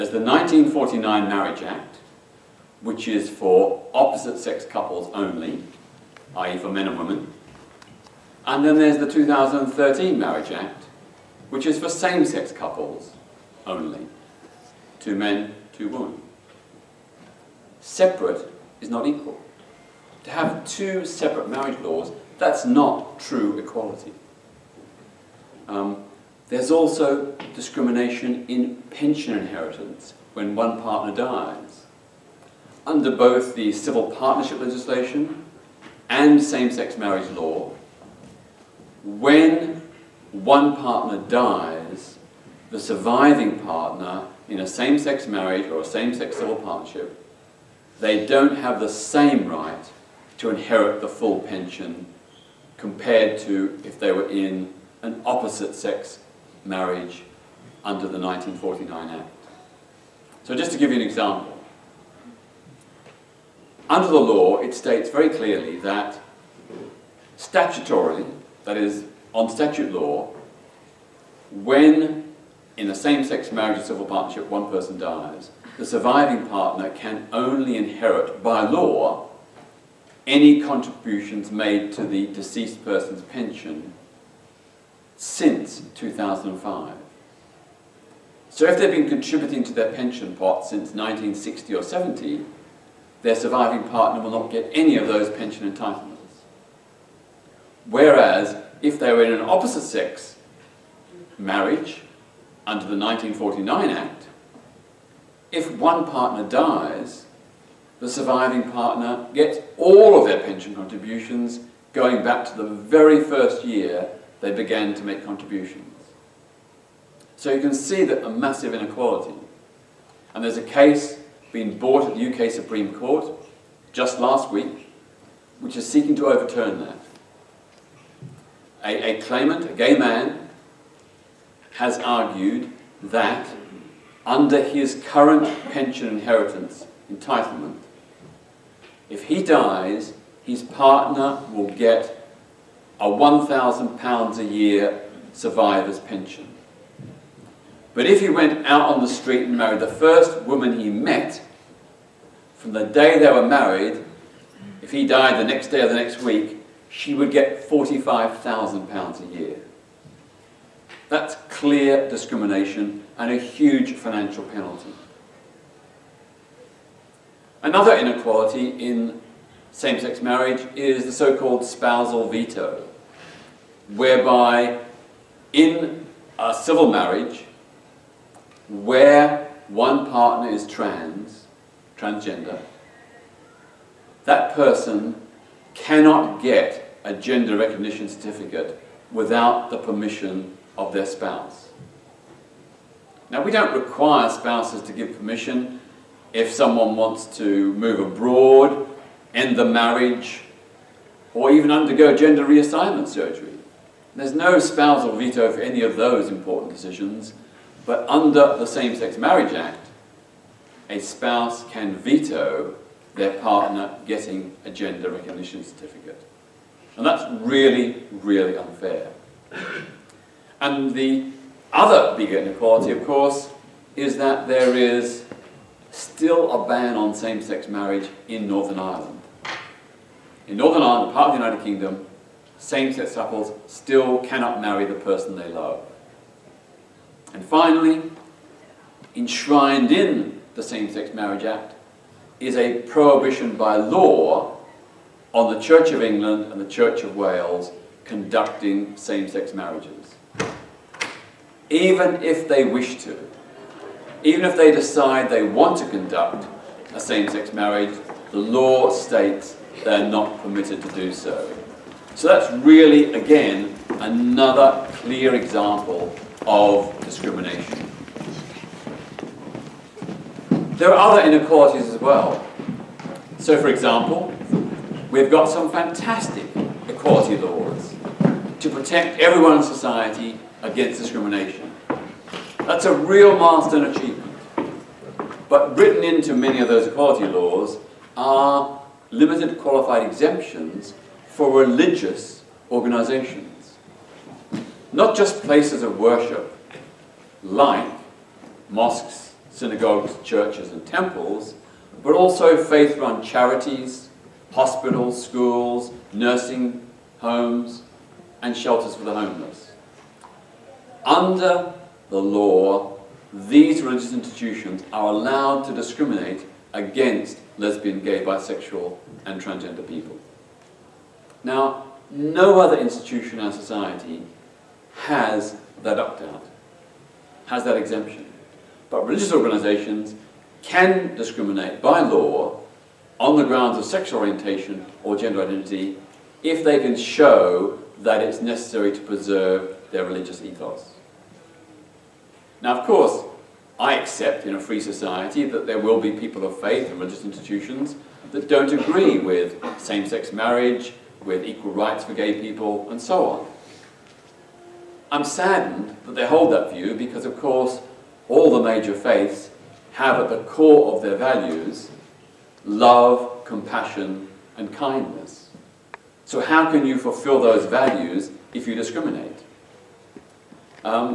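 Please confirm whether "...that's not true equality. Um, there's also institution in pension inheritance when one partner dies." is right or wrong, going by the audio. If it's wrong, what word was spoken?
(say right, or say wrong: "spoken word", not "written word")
wrong: "discrimination", not "institution".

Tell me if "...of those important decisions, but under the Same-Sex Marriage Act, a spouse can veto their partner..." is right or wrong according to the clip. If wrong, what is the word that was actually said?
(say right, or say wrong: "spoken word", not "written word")
right.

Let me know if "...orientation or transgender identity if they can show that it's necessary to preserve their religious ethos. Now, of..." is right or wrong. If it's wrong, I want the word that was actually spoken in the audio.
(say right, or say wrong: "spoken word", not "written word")
wrong: "gender", not "transgender".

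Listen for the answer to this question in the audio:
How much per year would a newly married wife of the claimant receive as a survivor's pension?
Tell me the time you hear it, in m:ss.
2:37.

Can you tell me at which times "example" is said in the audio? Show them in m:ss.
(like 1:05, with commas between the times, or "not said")
1:01, 4:25, 4:33.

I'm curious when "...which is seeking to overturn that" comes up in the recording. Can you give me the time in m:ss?
2:05.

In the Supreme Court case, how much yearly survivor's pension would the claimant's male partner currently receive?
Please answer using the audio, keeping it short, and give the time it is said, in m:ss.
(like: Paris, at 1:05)
£1,000, at 2:23.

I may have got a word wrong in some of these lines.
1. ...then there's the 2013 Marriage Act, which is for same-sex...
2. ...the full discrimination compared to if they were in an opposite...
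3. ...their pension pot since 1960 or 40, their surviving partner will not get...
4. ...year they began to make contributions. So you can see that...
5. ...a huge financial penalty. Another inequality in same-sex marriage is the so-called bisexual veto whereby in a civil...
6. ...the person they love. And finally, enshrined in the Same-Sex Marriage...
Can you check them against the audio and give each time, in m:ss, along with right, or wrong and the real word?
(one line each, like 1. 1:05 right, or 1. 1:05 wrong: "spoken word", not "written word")
1. 0:08 right
2. 0:50 wrong: "pension", not "discrimination"
3. 1:29 wrong: "70", not "40"
4. 1:53 right
5. 2:43 wrong: "spousal", not "bisexual"
6. 3:54 right.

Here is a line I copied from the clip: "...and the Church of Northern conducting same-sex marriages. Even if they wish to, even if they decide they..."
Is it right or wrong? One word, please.
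wrong.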